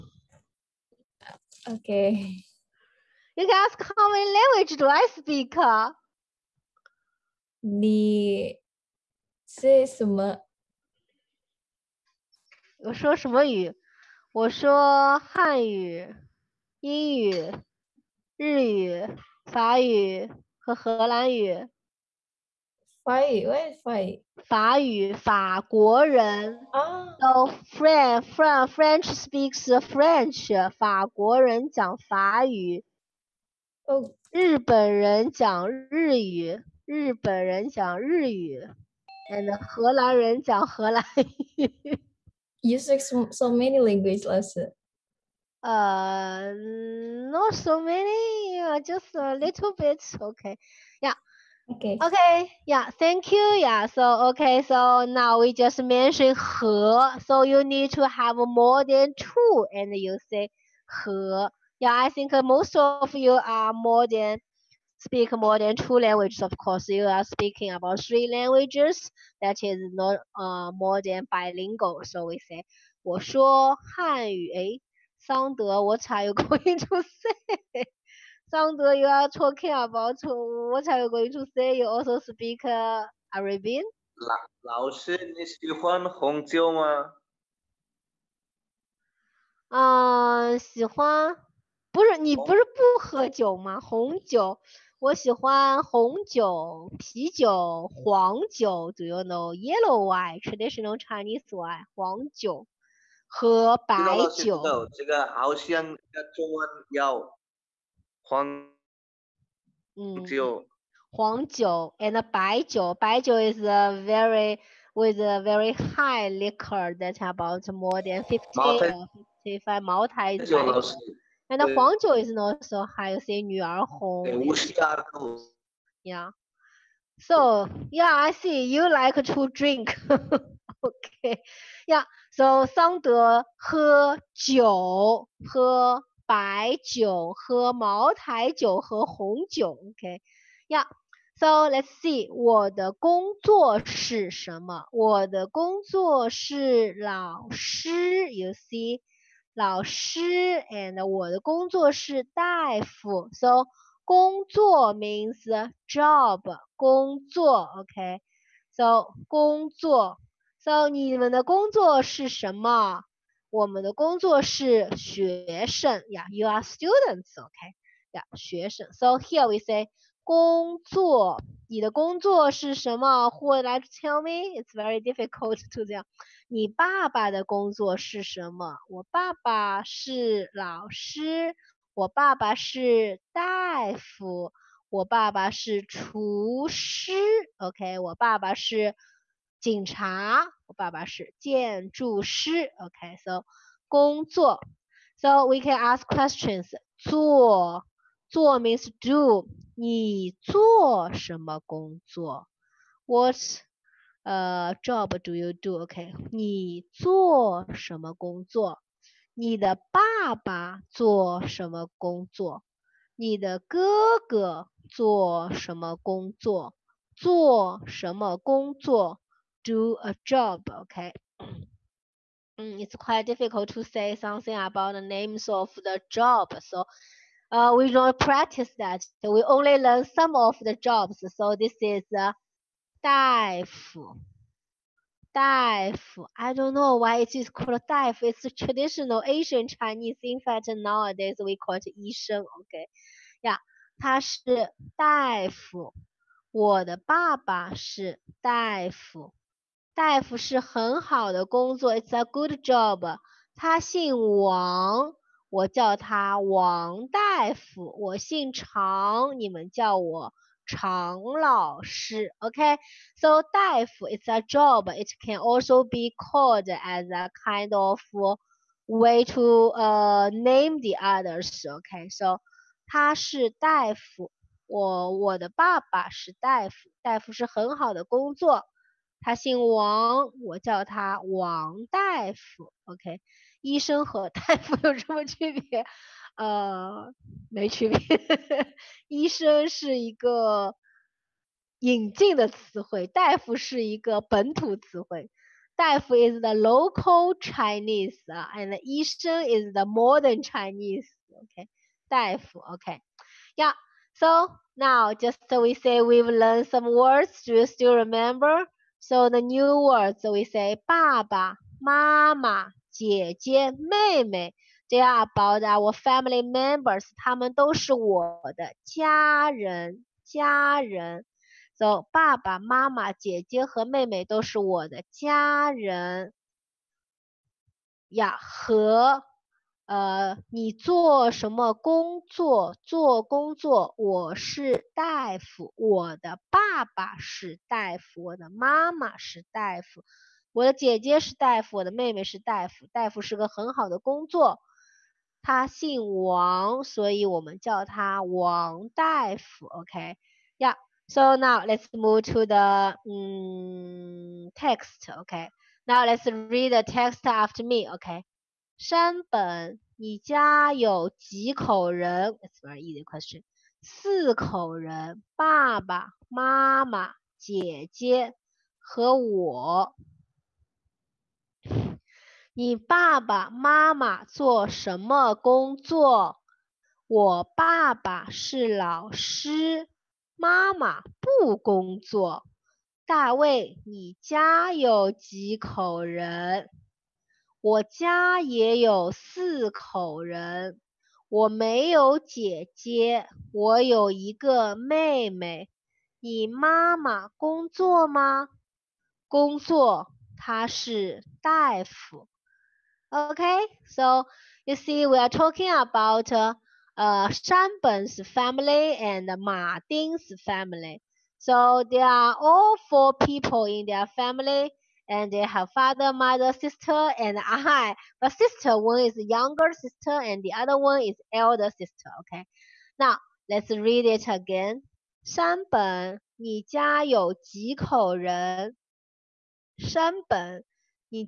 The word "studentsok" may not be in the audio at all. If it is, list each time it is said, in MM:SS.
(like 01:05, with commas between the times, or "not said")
02:46.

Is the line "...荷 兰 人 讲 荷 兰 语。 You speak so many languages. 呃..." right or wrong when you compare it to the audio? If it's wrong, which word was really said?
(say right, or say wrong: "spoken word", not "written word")
right.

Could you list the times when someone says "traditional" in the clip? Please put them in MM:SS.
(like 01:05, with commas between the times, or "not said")
01:40, 03:58.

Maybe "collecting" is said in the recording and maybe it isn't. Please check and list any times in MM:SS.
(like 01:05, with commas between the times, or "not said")
not said.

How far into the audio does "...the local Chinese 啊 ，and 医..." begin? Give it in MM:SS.
04:56.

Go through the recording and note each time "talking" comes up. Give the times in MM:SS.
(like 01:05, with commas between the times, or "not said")
01:19, 06:45.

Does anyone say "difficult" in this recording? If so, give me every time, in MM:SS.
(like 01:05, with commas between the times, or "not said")
02:55, 03:43.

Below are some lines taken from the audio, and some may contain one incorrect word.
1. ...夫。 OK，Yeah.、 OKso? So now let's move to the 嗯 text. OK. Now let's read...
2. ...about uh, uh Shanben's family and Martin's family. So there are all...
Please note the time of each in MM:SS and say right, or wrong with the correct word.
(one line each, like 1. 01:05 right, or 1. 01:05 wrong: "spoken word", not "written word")
1. 05:49 wrong: "Okay", not "OKso"
2. 06:45 right.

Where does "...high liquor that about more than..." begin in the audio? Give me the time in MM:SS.
01:55.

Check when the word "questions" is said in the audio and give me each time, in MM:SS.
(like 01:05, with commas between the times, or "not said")
03:16, 06:03.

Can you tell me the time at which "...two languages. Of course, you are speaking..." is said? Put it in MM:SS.
01:05.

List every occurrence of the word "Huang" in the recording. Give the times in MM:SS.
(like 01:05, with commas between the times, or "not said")
01:48, 02:01.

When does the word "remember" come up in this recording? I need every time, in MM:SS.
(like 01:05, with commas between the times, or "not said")
05:07.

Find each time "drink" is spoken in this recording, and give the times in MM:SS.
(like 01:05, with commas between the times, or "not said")
02:09.